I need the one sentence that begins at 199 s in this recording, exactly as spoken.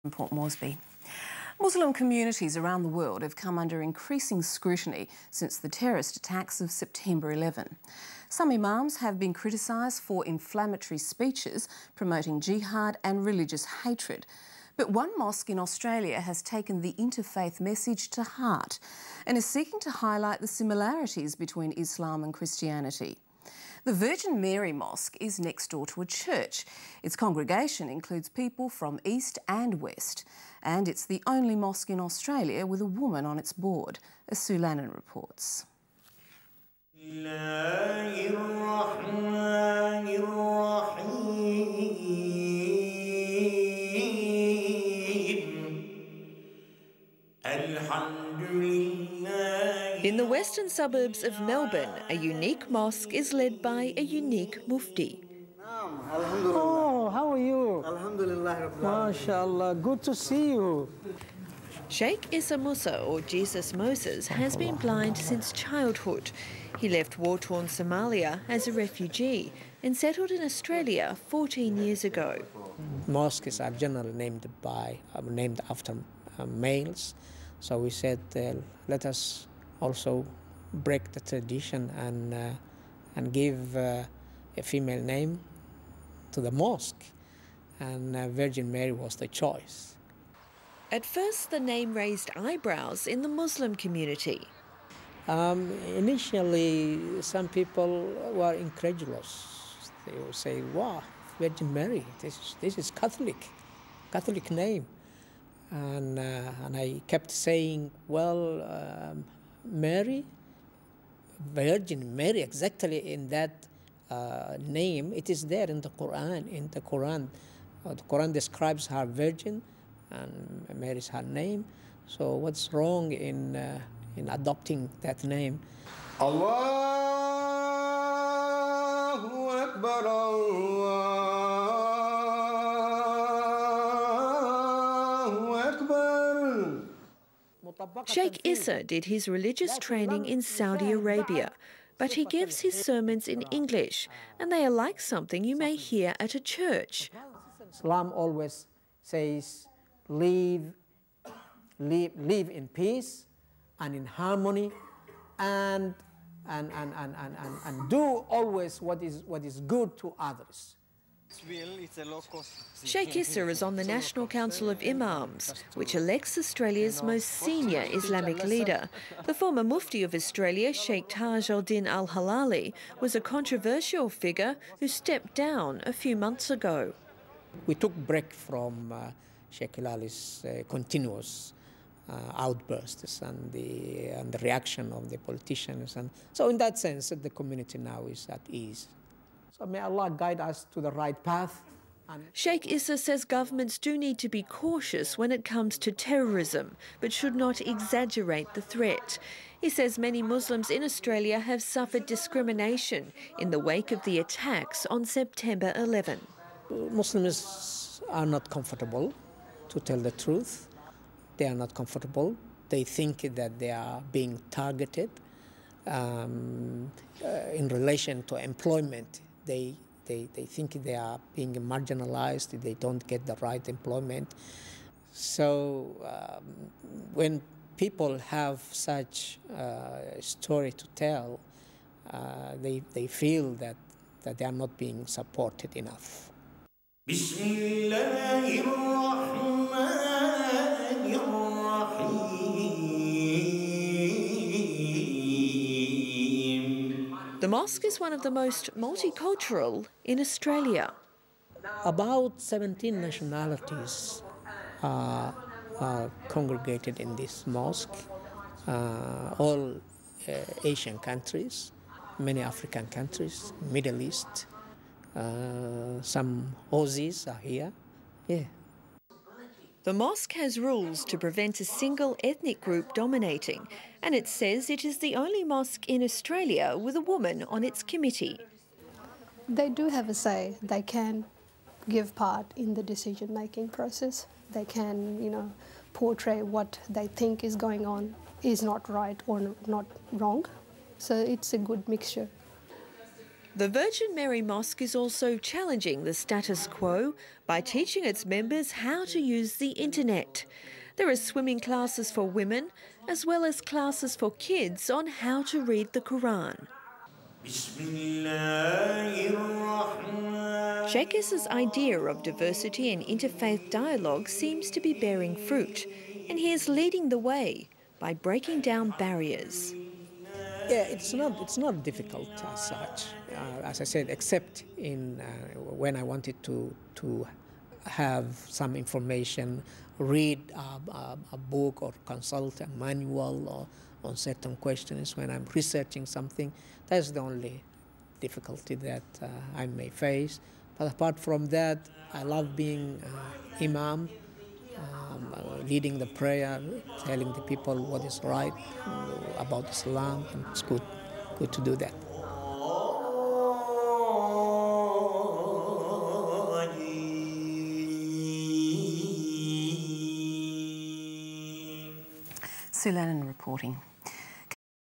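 He says many Muslims in Australia have suffered discrimination in the wake of the attacks on September 11.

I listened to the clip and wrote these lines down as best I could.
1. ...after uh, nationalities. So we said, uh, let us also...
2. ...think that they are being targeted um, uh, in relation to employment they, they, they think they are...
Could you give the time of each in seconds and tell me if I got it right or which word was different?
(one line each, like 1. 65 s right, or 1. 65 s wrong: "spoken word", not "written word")
1. 75 s wrong: "males", not "nationalities"
2. 212 s right.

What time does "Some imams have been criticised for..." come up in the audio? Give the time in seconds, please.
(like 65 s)
8 s.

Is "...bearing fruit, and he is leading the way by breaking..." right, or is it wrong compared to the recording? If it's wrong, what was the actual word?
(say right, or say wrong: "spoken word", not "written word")
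right.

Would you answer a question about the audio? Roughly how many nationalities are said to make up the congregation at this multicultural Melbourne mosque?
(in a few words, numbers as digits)
17.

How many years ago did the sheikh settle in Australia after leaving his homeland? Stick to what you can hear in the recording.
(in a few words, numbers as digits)
14.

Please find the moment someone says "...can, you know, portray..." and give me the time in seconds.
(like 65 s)
284 s.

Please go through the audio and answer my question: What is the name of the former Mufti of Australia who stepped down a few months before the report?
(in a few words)
Sheikh Taj al-Din al-Hilali.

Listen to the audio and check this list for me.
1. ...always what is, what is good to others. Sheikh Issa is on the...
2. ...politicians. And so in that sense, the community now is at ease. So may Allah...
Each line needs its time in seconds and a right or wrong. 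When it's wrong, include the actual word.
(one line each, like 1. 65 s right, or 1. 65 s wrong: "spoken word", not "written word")
1. 158 s right
2. 185 s right.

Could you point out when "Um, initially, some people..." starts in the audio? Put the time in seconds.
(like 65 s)
95 s.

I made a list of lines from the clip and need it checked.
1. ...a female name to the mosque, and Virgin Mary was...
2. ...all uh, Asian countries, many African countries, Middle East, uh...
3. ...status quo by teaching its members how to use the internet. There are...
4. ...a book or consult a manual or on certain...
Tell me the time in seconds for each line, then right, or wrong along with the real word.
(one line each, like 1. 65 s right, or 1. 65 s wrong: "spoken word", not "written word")
1. 83 s right
2. 259 s right
3. 296 s right
4. 331 s right.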